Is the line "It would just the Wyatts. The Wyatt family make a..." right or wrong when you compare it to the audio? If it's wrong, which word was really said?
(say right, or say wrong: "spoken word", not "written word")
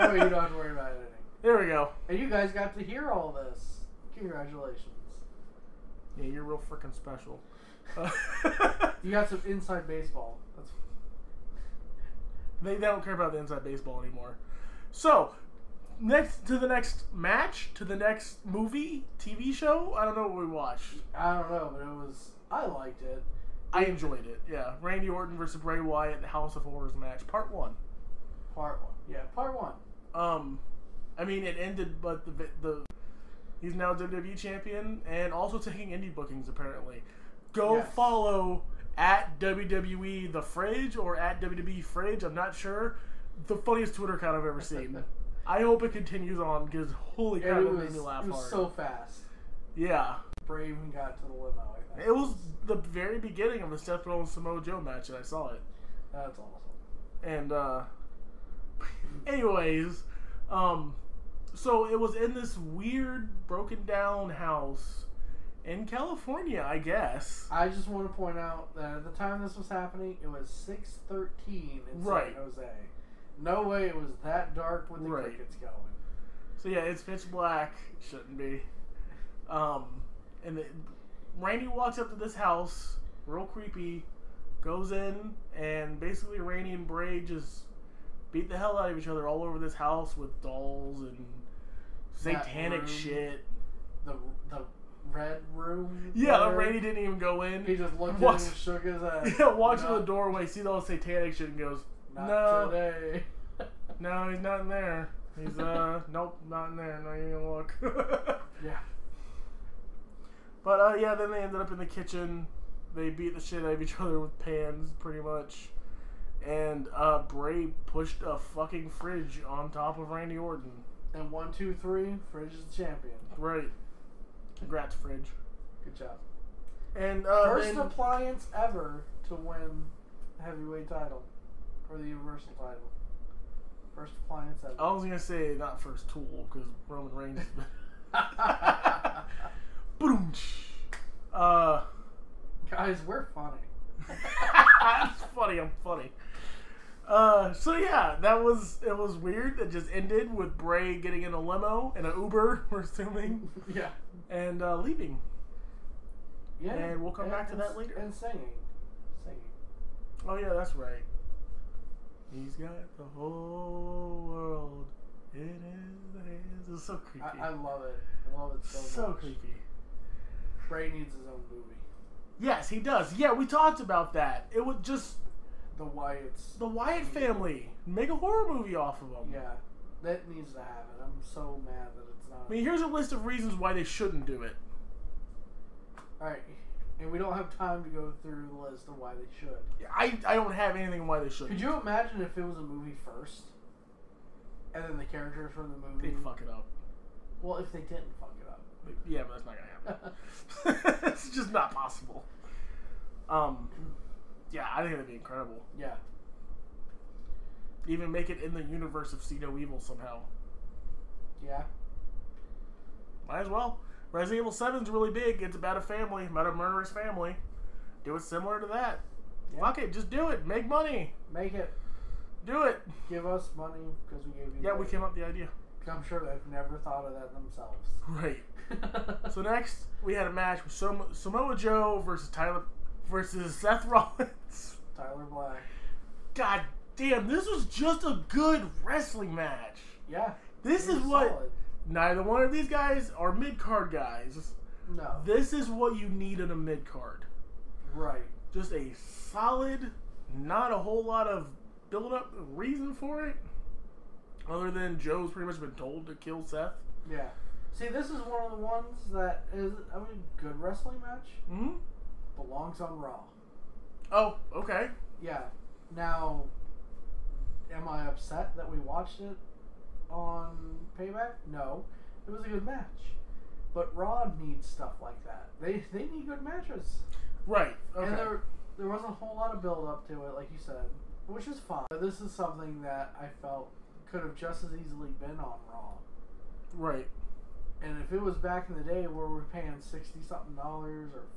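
right.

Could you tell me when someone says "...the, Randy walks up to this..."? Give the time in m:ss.
1:20.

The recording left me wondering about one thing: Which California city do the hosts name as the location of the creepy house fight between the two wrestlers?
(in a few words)
San Jose.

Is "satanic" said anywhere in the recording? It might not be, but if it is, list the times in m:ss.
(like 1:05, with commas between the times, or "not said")
1:32, 1:40.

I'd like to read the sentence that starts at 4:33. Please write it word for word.
But Raw needs stuff like that.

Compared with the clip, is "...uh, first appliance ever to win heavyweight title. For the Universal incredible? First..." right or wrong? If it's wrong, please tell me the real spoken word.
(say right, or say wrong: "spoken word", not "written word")
wrong: "title", not "incredible".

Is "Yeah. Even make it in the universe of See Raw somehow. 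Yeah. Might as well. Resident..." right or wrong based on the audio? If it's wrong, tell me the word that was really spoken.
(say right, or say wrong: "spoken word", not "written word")
wrong: "Evil", not "Raw".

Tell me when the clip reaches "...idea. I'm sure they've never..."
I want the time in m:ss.
3:45.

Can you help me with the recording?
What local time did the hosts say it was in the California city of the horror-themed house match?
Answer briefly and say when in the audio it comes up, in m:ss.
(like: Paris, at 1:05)
6:13, at 1:10.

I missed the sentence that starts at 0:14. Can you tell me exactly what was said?
So, next to the next match, to the next movie, TV show.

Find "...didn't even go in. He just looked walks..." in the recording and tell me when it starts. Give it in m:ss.
1:36.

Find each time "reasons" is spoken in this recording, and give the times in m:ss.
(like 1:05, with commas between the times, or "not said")
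3:03, 4:12.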